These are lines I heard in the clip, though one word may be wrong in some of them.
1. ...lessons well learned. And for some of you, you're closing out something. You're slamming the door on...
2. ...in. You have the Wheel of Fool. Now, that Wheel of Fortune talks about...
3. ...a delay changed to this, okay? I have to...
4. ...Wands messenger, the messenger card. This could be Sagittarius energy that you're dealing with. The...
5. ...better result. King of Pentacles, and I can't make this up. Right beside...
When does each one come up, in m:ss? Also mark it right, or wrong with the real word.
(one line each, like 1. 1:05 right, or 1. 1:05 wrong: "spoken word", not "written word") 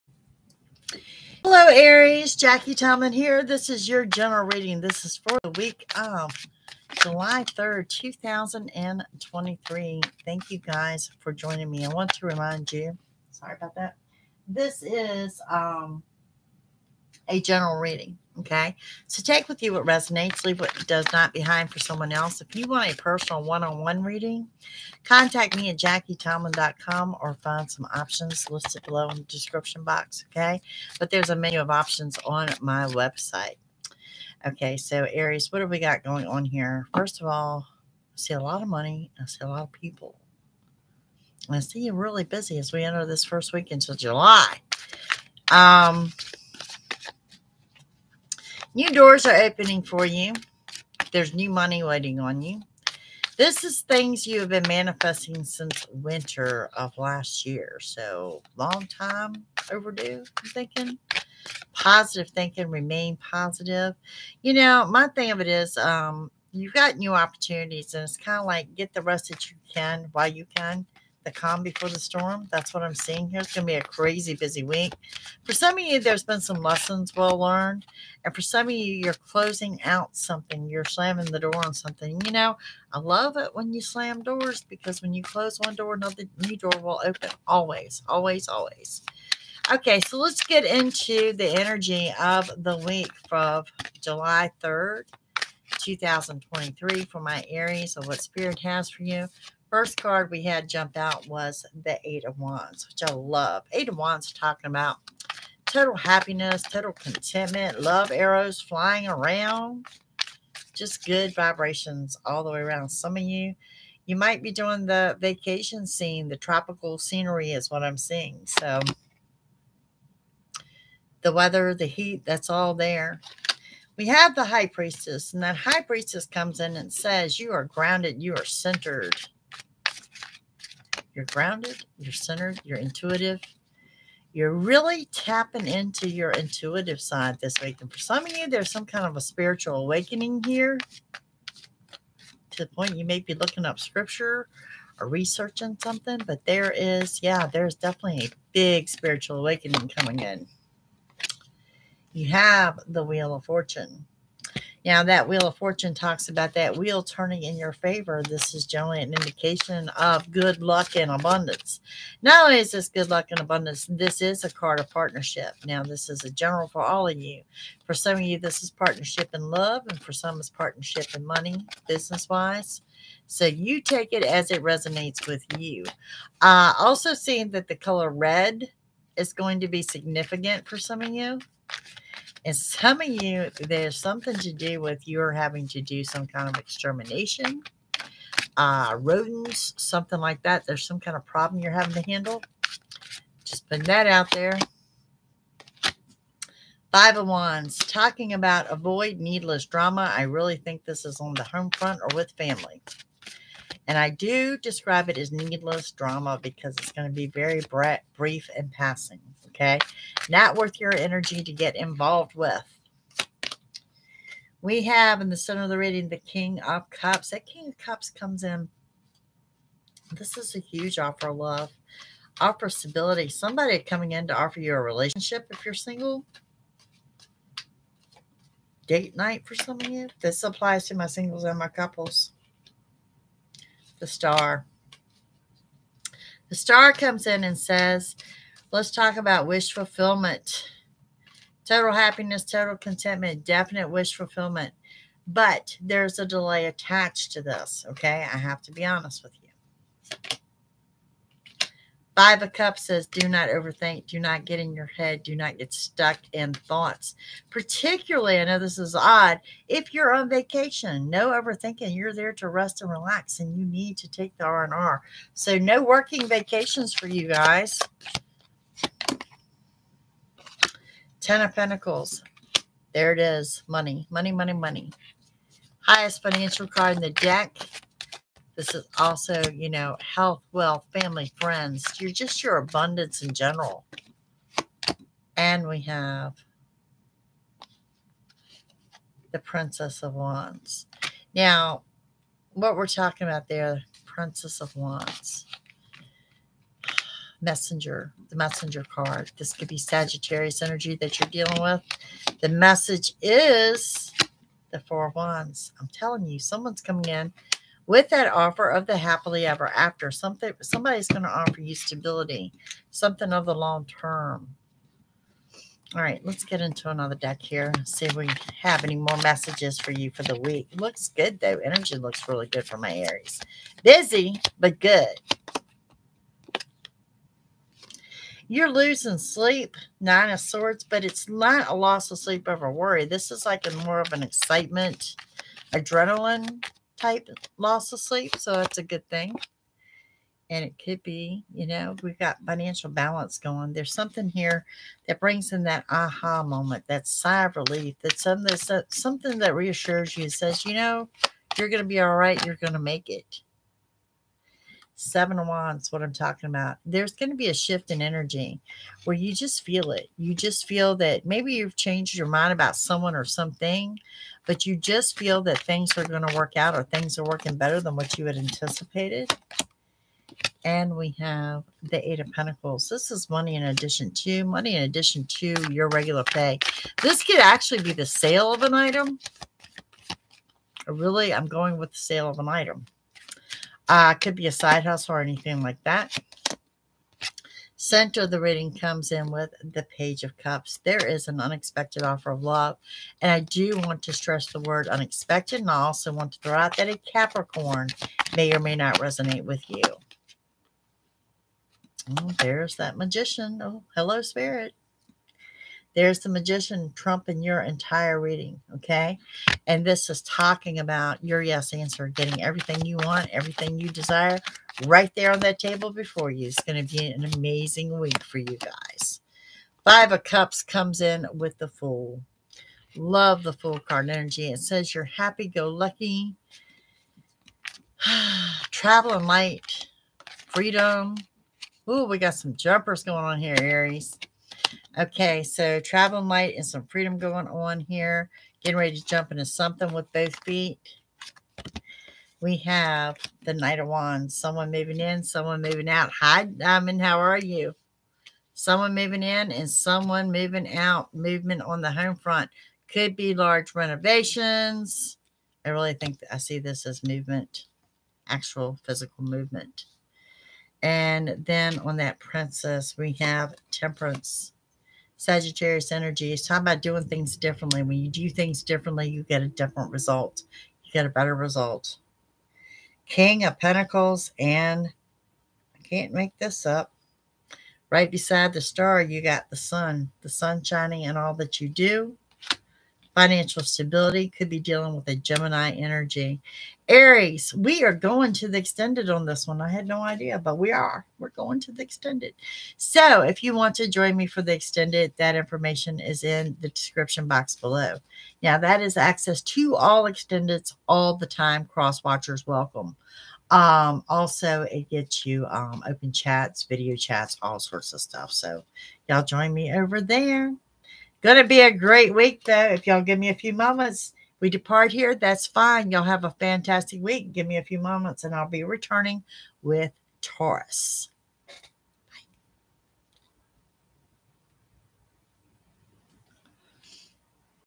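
1. 1:16 right
2. 2:30 wrong: "Fortune", not "Fool"
3. 4:06 wrong: "attached", not "changed"
4. 4:54 right
5. 7:51 right.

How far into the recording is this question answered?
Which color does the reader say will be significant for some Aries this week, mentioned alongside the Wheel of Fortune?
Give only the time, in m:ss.
2:58.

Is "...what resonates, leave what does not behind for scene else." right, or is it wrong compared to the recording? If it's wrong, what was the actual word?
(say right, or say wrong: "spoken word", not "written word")
wrong: "someone", not "scene".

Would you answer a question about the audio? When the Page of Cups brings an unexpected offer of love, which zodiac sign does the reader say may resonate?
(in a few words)
Capricorn.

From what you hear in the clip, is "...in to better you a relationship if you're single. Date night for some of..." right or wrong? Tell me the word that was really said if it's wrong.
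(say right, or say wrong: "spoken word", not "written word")
wrong: "offer", not "better".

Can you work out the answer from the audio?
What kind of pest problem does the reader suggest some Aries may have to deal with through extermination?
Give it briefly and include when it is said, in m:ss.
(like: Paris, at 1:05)
rodents, at 3:08.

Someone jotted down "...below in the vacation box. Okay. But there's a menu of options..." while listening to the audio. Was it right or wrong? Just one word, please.
wrong.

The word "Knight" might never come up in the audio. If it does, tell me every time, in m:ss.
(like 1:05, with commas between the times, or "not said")
7:23.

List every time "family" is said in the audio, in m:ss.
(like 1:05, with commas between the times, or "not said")
3:22, 4:40.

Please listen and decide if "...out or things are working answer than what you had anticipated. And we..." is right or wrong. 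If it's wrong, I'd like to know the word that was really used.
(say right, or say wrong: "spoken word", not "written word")
wrong: "better", not "answer".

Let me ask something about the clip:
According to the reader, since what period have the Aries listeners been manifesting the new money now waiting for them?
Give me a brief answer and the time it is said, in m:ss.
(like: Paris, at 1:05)
winter of last year, at 0:55.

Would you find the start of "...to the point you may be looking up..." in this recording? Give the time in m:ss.
2:22.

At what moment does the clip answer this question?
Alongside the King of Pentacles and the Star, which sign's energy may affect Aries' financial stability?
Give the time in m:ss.
8:05.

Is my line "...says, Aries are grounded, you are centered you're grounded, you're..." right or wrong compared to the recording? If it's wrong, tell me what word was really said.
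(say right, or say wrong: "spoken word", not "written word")
wrong: "You", not "Aries".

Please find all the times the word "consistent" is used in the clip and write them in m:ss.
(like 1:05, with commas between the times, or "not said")
not said.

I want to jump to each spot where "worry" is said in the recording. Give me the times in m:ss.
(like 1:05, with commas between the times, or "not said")
5:32.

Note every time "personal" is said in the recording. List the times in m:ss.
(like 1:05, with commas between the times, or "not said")
0:22.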